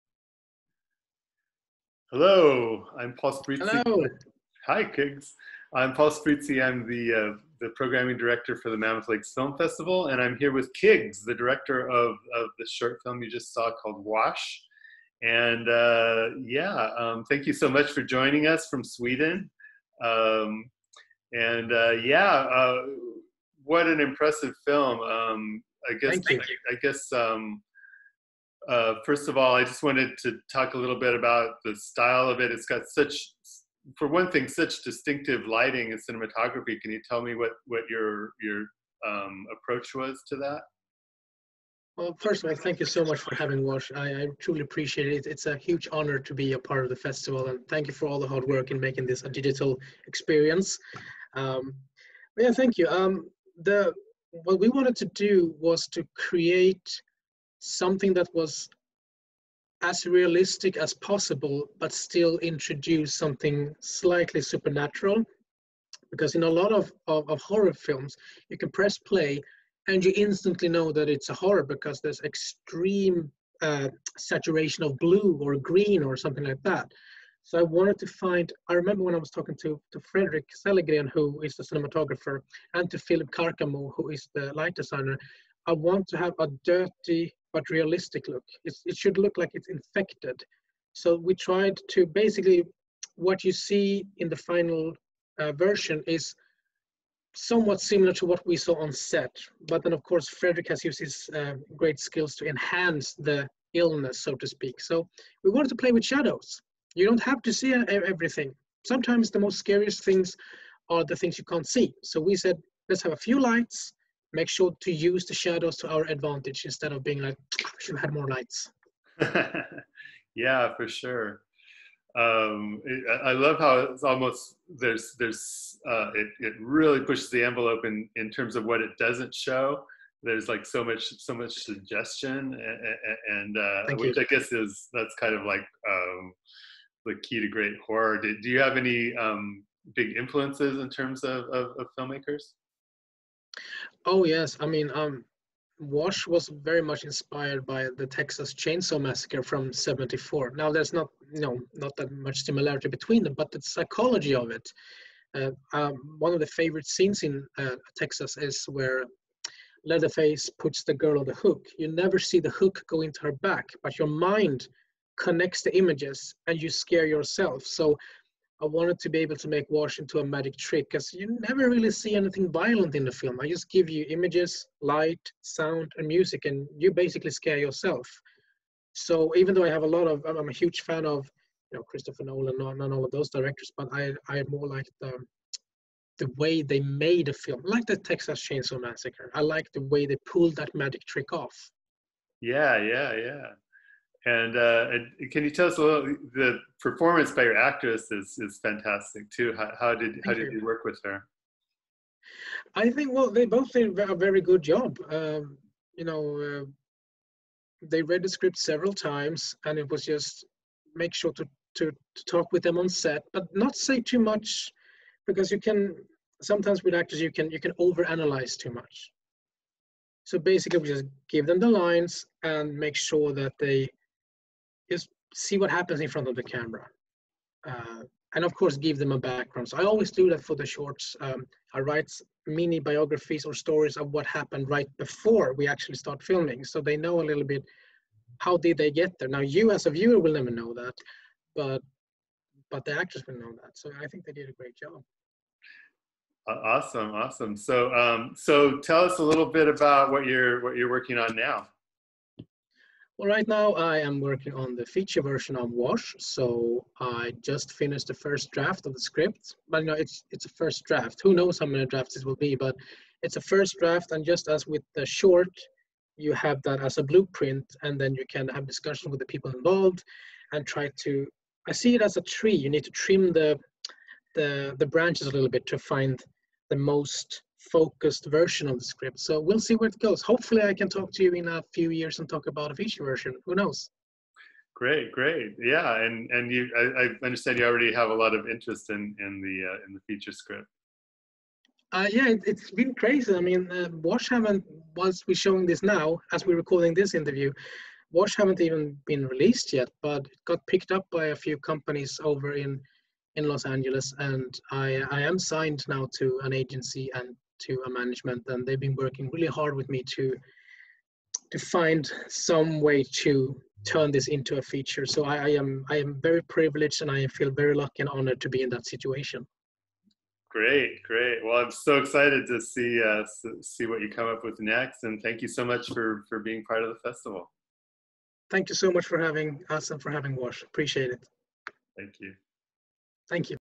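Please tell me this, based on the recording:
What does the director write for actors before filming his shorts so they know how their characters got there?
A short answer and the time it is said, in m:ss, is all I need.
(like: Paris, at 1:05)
Mini biographies, at 3:52.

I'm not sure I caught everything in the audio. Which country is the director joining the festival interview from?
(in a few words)
Sweden.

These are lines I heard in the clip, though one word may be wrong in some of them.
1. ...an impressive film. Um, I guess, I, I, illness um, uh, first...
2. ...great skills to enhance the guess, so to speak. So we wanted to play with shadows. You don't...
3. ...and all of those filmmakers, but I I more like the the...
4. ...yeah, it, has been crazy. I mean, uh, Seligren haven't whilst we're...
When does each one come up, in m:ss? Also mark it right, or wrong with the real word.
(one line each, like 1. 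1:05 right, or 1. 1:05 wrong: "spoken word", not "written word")
1. 0:23 wrong: "guess", not "illness"
2. 1:41 wrong: "illness", not "guess"
3. 3:02 wrong: "directors", not "filmmakers"
4. 4:52 wrong: "Wash", not "Seligren".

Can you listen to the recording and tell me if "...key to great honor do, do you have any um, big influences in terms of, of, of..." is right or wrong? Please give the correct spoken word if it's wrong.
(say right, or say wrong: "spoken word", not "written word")
wrong: "horror", not "honor".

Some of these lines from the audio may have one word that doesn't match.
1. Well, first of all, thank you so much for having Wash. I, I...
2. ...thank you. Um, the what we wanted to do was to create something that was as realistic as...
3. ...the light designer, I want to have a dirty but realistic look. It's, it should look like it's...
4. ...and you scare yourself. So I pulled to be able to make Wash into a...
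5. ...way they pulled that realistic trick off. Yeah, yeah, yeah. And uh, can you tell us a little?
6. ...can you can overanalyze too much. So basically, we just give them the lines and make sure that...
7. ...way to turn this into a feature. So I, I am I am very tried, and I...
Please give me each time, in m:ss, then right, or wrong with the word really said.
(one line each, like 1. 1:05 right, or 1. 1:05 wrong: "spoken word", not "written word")
1. 0:41 right
2. 0:52 right
3. 1:24 right
4. 2:46 wrong: "wanted", not "pulled"
5. 3:09 wrong: "magic", not "realistic"
6. 3:37 right
7. 5:12 wrong: "privileged", not "tried".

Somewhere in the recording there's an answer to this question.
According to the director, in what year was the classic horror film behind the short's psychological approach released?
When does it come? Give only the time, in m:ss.
2:29.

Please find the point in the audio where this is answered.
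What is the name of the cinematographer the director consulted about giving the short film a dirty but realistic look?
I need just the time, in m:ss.
1:20.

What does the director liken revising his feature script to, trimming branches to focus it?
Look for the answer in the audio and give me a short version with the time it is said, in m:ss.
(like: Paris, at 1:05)
A tree, at 4:32.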